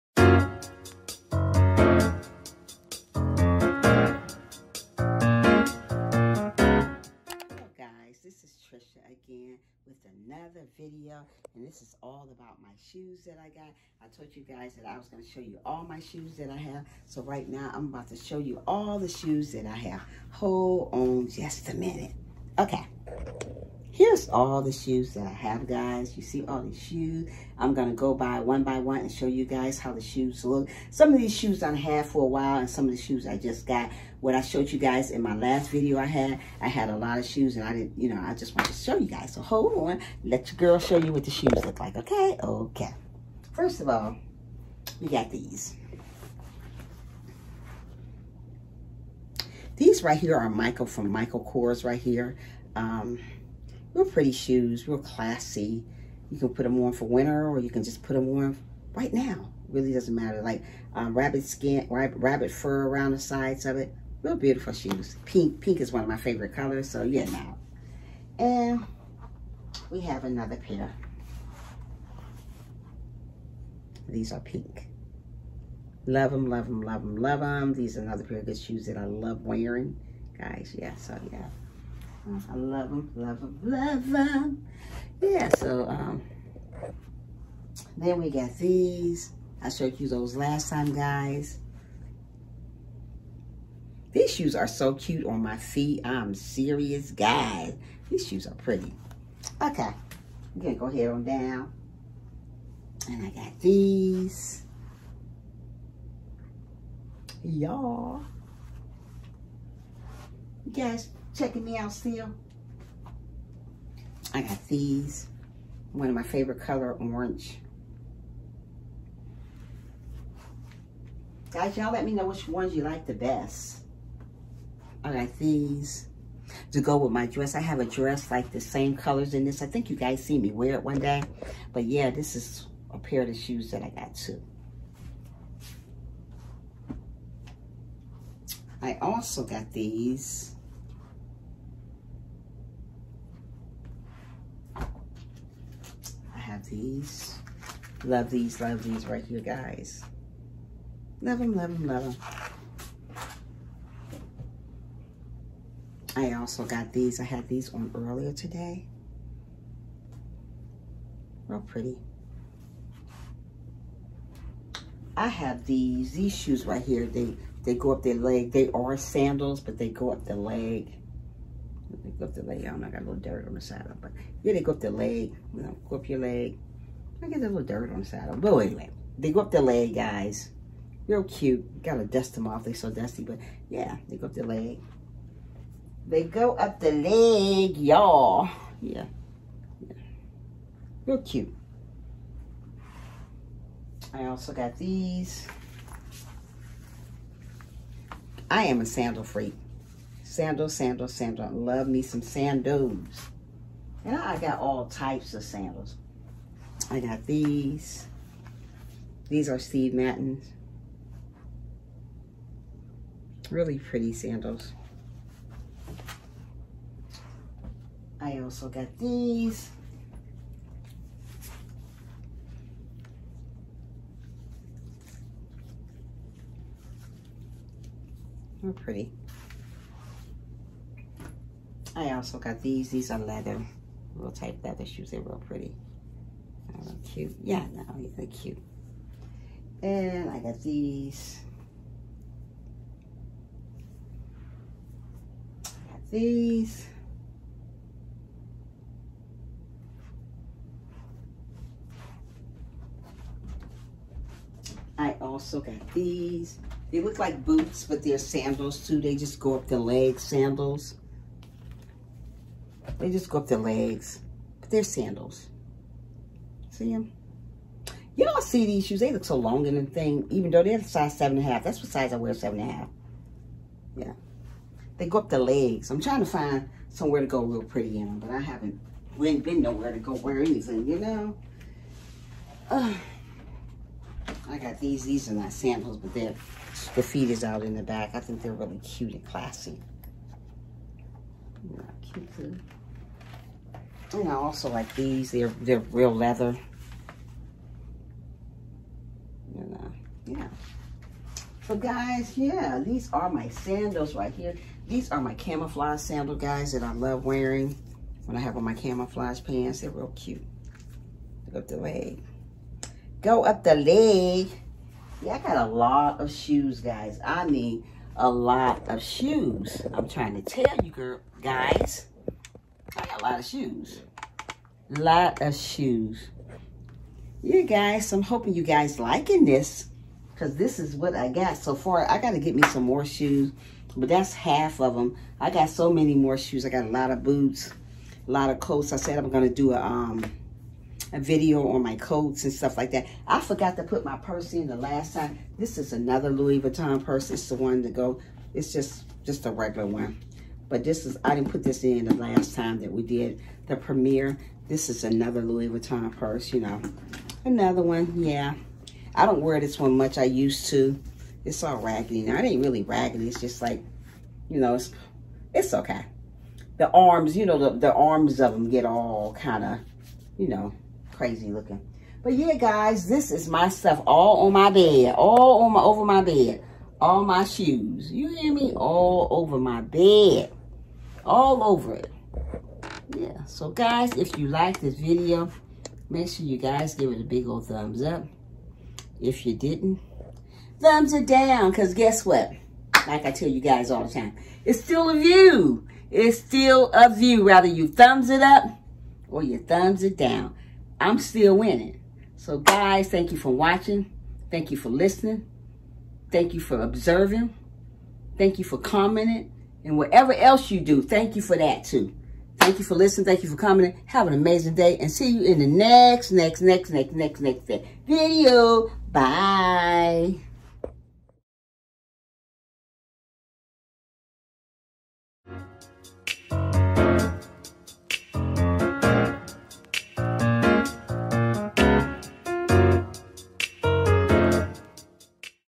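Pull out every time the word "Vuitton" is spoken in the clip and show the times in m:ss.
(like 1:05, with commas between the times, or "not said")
5:46, 5:55.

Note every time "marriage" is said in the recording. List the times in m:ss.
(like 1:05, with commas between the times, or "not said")
not said.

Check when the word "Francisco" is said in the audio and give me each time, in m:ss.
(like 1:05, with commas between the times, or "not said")
not said.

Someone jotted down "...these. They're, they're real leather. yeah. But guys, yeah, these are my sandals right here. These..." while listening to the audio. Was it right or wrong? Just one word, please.
right.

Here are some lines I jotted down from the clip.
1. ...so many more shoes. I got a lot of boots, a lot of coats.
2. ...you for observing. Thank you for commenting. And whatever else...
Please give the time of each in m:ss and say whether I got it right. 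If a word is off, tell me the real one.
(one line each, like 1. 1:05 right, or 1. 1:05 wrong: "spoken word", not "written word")
1. 5:35 right
2. 6:46 right.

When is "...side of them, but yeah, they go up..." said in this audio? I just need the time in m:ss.
2:53.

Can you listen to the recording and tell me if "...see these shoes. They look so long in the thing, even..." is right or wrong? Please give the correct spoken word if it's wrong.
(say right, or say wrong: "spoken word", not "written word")
right.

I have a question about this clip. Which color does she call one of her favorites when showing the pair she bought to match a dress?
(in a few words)
Orange.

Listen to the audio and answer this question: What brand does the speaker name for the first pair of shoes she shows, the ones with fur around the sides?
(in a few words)
Michael Kors.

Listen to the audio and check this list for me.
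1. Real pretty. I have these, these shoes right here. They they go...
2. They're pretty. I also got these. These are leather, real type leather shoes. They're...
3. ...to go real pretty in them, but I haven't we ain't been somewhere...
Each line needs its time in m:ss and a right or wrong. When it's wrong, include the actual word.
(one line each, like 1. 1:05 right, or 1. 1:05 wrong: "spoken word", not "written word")
1. 2:41 right
2. 3:48 right
3. 4:37 wrong: "nowhere", not "somewhere".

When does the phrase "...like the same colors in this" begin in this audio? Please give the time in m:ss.
2:08.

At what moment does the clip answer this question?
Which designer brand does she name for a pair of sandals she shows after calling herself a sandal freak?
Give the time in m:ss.
3:29.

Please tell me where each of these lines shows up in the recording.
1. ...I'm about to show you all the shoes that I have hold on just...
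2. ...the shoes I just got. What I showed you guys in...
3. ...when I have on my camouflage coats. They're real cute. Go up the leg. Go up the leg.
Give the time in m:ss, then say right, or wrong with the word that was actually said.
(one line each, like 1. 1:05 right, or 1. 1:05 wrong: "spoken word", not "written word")
1. 0:17 right
2. 0:32 right
3. 5:08 wrong: "pants", not "coats".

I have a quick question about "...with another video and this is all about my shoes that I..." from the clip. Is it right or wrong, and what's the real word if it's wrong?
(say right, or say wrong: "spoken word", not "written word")
right.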